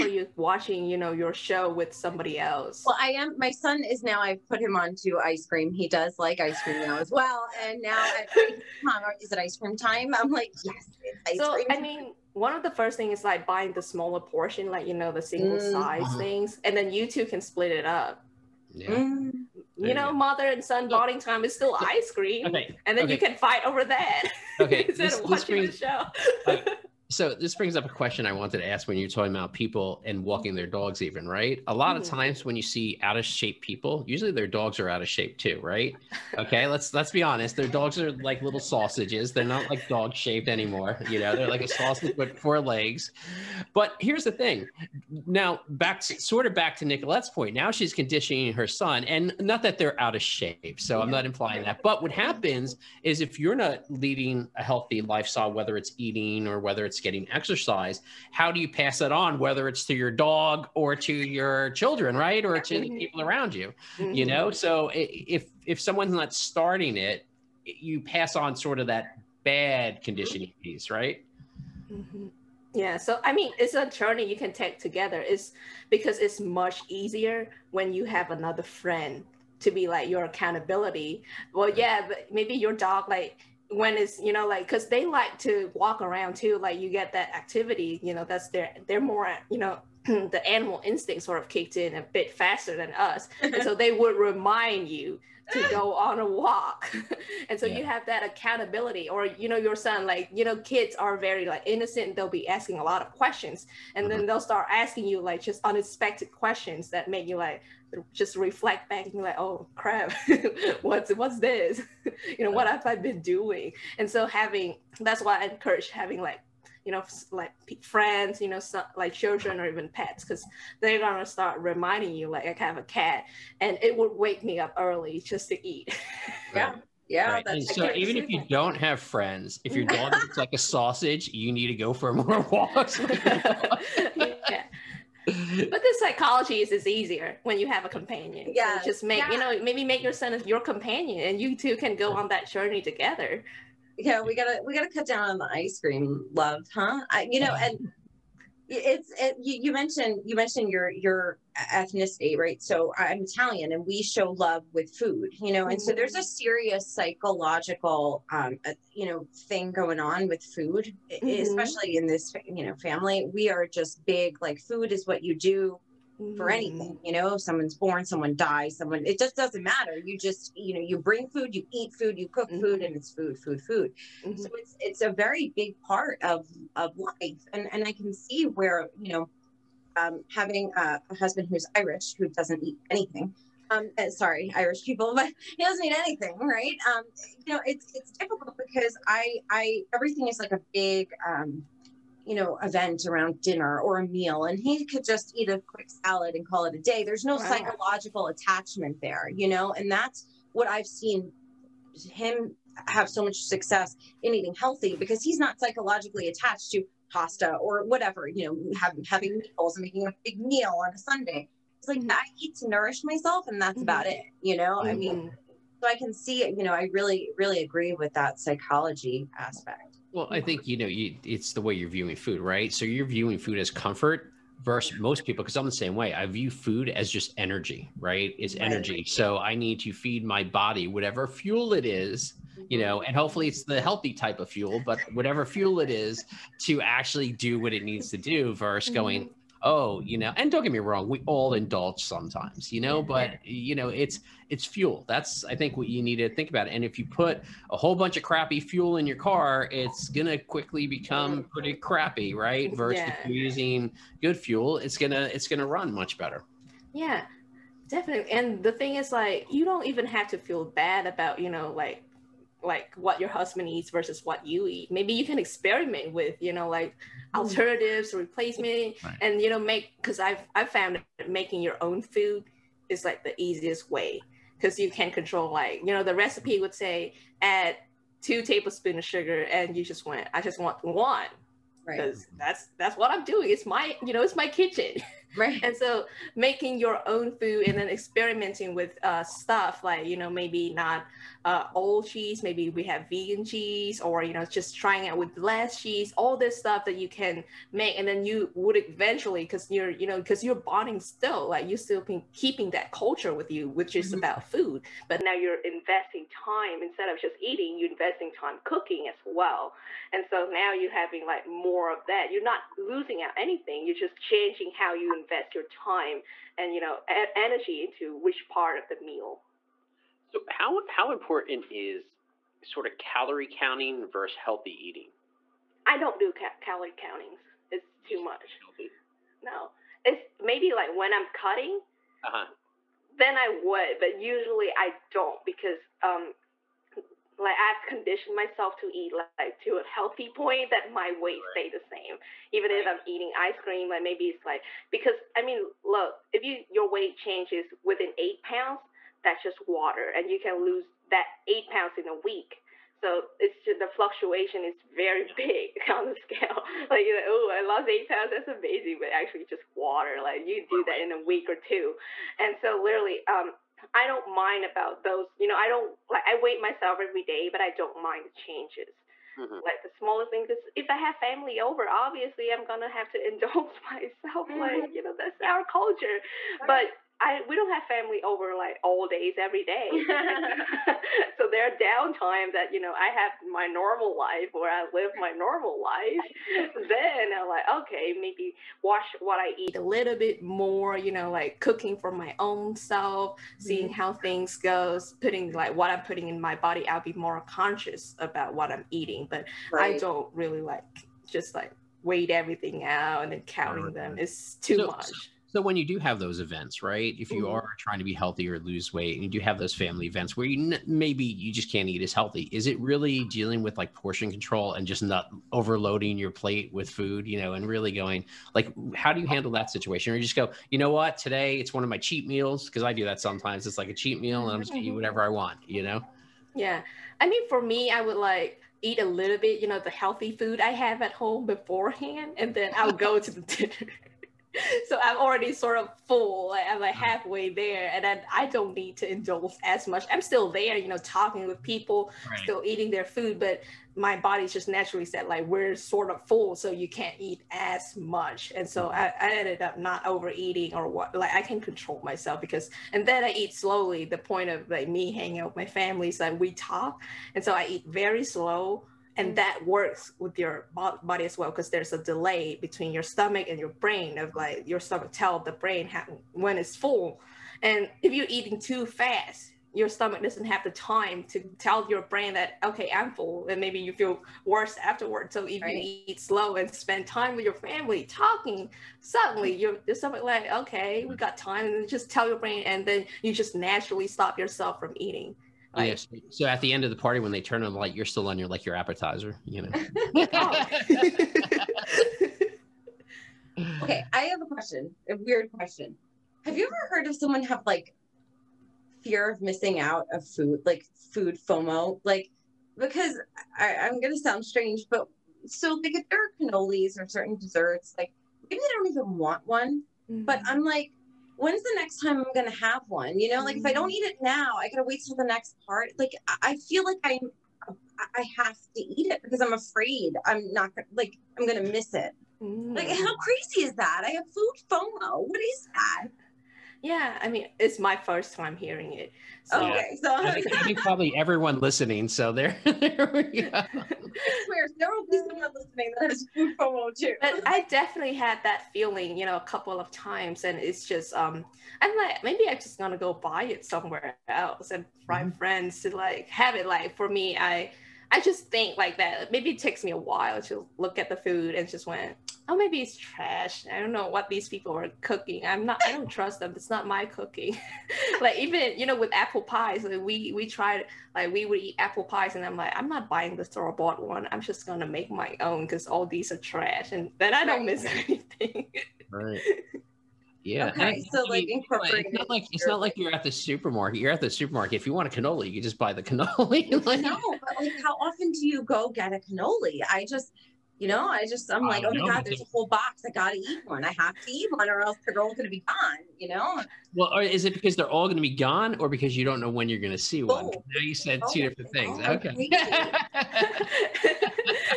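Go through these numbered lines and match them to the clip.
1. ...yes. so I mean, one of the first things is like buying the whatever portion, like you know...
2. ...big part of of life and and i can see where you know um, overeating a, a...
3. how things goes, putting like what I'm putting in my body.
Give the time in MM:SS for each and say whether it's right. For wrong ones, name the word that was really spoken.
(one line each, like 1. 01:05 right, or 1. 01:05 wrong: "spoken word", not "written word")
1. 00:10 wrong: "smaller", not "whatever"
2. 02:55 wrong: "having", not "overeating"
3. 06:33 right.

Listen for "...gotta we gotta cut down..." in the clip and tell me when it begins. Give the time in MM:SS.
02:24.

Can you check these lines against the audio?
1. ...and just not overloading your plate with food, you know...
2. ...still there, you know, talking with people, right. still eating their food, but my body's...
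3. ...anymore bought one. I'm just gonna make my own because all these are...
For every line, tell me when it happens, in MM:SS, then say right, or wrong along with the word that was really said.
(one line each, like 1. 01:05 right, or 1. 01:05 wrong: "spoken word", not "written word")
1. 06:54 right
2. 07:20 right
3. 09:23 wrong: "store", not "anymore".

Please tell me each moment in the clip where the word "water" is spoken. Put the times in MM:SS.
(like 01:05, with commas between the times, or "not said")
05:49, 05:59.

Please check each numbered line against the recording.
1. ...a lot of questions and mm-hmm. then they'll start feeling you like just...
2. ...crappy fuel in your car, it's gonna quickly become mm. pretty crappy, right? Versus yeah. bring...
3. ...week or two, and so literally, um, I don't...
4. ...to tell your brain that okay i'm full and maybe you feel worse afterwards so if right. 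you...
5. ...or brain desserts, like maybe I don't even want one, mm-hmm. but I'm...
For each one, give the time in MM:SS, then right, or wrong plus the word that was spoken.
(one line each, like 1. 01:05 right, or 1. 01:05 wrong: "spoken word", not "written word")
1. 01:42 wrong: "asking", not "feeling"
2. 04:08 wrong: "using", not "bring"
3. 06:01 right
4. 07:51 right
5. 08:26 wrong: "certain", not "brain".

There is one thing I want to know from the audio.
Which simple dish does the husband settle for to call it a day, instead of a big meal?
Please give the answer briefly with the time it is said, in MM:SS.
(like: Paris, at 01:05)
A quick salad, at 03:15.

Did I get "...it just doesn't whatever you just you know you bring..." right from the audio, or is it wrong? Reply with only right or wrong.
wrong.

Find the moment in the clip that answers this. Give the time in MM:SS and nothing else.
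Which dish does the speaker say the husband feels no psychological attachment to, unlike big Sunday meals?
03:27.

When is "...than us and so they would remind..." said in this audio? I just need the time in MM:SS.
01:32.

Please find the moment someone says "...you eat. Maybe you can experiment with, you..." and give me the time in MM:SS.
04:24.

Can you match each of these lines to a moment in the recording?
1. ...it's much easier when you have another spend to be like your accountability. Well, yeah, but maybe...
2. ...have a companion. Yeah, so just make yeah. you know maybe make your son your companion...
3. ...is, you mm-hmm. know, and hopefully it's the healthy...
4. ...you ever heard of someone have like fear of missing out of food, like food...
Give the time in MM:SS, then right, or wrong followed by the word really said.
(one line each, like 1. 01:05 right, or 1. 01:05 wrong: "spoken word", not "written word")
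1. 01:16 wrong: "friend", not "spend"
2. 02:17 right
3. 03:51 right
4. 08:16 right.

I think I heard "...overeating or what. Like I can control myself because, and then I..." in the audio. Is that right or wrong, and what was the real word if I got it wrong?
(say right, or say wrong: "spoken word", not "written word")
right.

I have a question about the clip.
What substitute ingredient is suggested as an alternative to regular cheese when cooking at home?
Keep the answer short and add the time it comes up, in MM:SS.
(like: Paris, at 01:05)
Vegan cheese, at 04:53.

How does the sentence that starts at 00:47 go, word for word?
Now she's conditioning her son, and not that they're out of shape.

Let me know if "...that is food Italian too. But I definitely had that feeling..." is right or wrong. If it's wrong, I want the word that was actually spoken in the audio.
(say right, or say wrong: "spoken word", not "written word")
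wrong: "FOMO", not "Italian".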